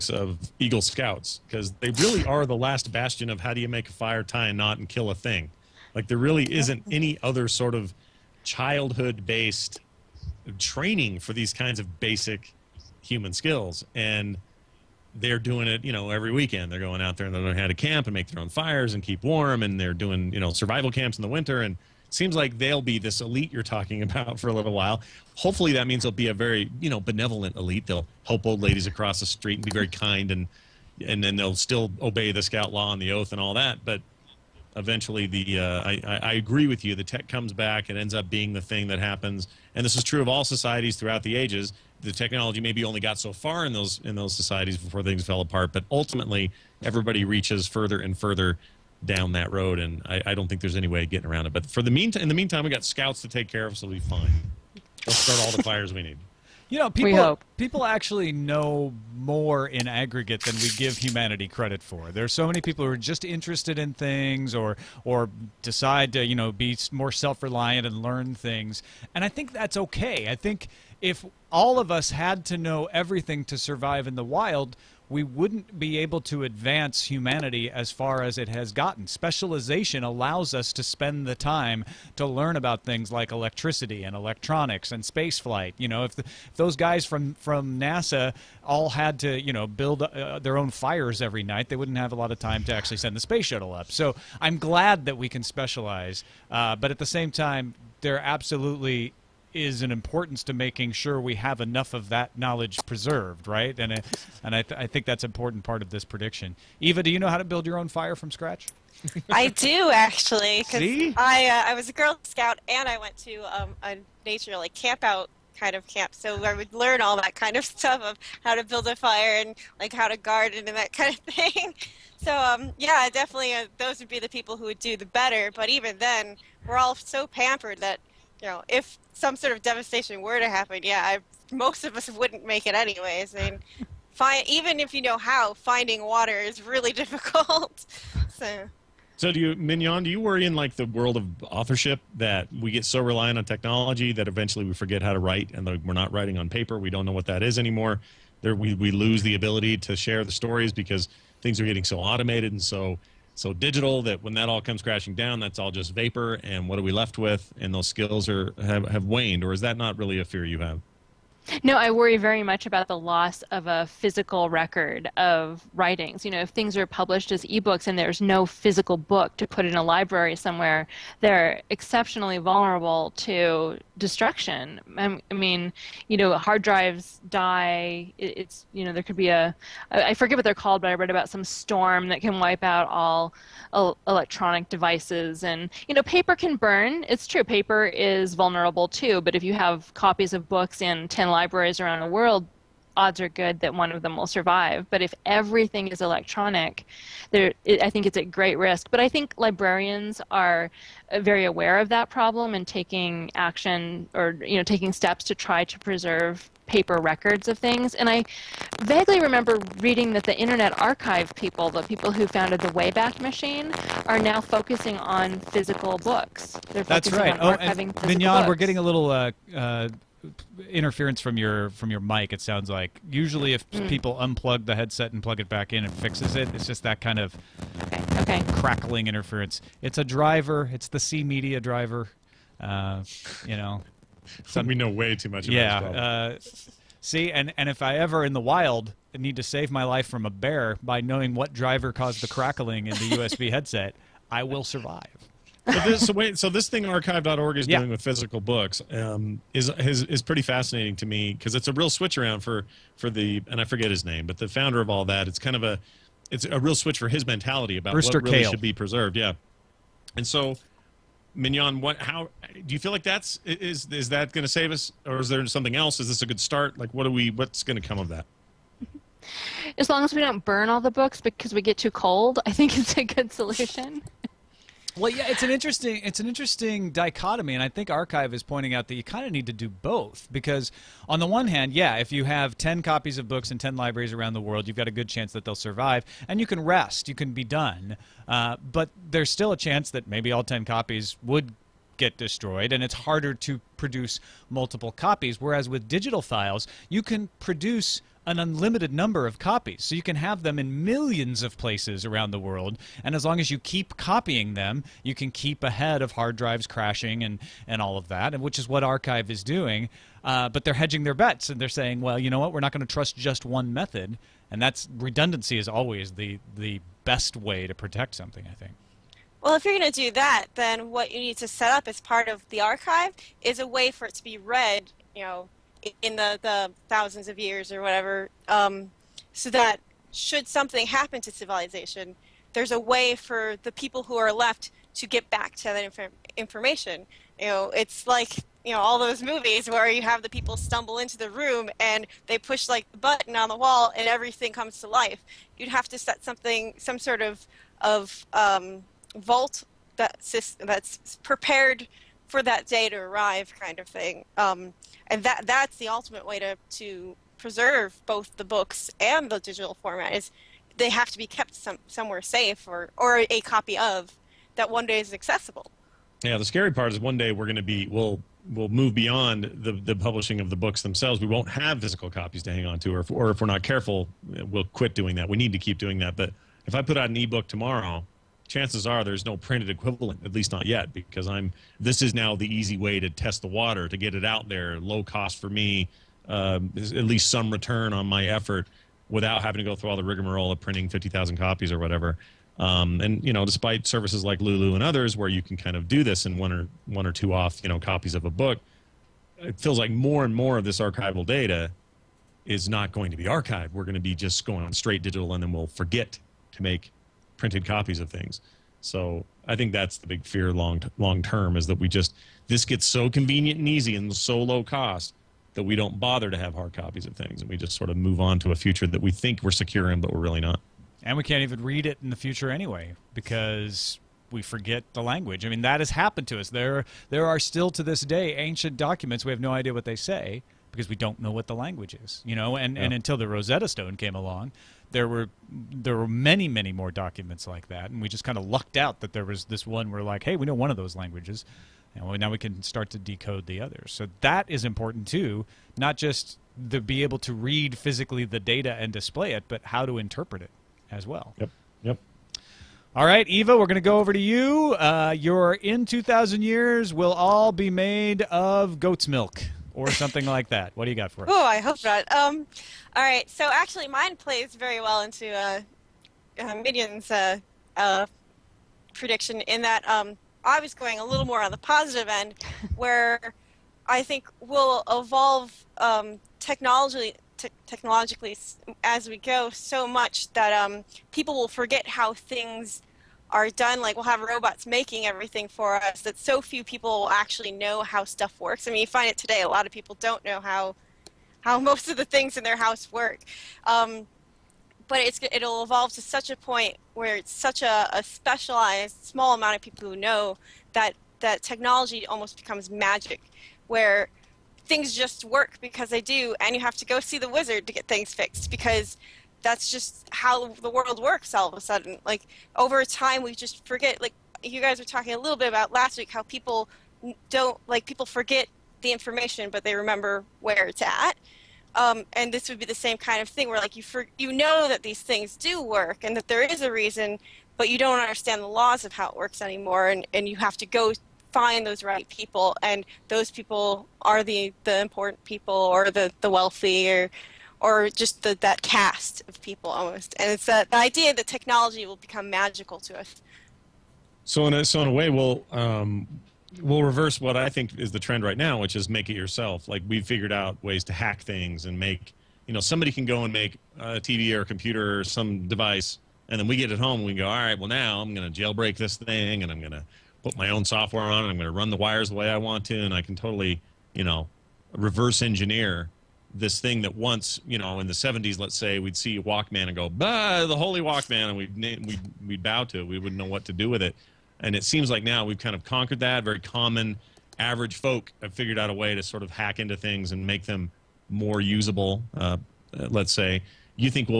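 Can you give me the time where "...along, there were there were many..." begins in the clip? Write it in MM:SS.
07:14.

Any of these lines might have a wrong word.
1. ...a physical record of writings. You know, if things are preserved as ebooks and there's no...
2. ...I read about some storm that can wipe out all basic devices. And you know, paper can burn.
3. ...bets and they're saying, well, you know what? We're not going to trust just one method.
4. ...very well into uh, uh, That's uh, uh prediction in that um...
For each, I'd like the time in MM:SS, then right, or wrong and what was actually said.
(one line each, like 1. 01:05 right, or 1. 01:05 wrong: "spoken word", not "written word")
1. 02:43 wrong: "published", not "preserved"
2. 03:00 wrong: "electronic", not "basic"
3. 05:11 right
4. 07:44 wrong: "Mignon", not "That".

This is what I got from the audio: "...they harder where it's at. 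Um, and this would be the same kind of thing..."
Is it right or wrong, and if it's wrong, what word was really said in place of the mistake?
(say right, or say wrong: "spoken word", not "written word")
wrong: "remember", not "harder".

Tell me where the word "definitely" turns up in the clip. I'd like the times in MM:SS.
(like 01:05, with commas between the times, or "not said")
02:03.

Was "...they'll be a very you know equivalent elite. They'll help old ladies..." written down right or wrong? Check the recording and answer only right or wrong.
wrong.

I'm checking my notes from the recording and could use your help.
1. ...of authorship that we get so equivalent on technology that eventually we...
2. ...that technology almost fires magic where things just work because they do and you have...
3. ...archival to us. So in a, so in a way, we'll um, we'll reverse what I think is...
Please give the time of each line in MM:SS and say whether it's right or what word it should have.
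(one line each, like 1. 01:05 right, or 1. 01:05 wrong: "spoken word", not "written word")
1. 02:21 wrong: "reliant", not "equivalent"
2. 08:21 wrong: "becomes", not "fires"
3. 09:02 wrong: "magical", not "archival".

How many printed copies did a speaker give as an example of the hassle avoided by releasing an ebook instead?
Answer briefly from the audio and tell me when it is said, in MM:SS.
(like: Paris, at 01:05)
50,000, at 06:30.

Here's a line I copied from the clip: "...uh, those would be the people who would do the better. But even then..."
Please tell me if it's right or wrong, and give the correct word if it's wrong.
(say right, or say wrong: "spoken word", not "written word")
right.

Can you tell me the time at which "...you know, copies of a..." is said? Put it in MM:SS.
06:37.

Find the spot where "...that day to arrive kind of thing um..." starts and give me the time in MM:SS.
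05:52.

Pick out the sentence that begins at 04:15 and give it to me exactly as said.
It's kind of a it's a real switch for his mentality about Brewster what really Kahle.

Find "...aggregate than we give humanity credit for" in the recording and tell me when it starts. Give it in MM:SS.
00:59.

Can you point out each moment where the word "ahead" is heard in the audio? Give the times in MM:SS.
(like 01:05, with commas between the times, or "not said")
05:05.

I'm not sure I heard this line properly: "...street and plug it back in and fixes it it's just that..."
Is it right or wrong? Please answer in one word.
wrong.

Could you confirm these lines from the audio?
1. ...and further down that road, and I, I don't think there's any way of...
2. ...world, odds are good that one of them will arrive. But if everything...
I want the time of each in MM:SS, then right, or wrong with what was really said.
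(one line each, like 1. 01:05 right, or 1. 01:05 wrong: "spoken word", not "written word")
1. 00:47 right
2. 03:12 wrong: "survive", not "arrive".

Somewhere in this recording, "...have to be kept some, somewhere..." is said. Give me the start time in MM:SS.
06:00.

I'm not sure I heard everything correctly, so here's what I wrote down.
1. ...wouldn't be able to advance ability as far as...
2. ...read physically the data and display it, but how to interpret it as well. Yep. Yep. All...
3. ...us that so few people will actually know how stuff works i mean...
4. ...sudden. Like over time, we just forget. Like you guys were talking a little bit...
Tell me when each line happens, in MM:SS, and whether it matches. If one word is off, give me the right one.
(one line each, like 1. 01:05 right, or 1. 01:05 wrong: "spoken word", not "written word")
1. 01:15 wrong: "humanity", not "ability"
2. 07:27 right
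3. 08:05 right
4. 08:31 right.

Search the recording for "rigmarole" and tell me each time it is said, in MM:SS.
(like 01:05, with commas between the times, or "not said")
06:30.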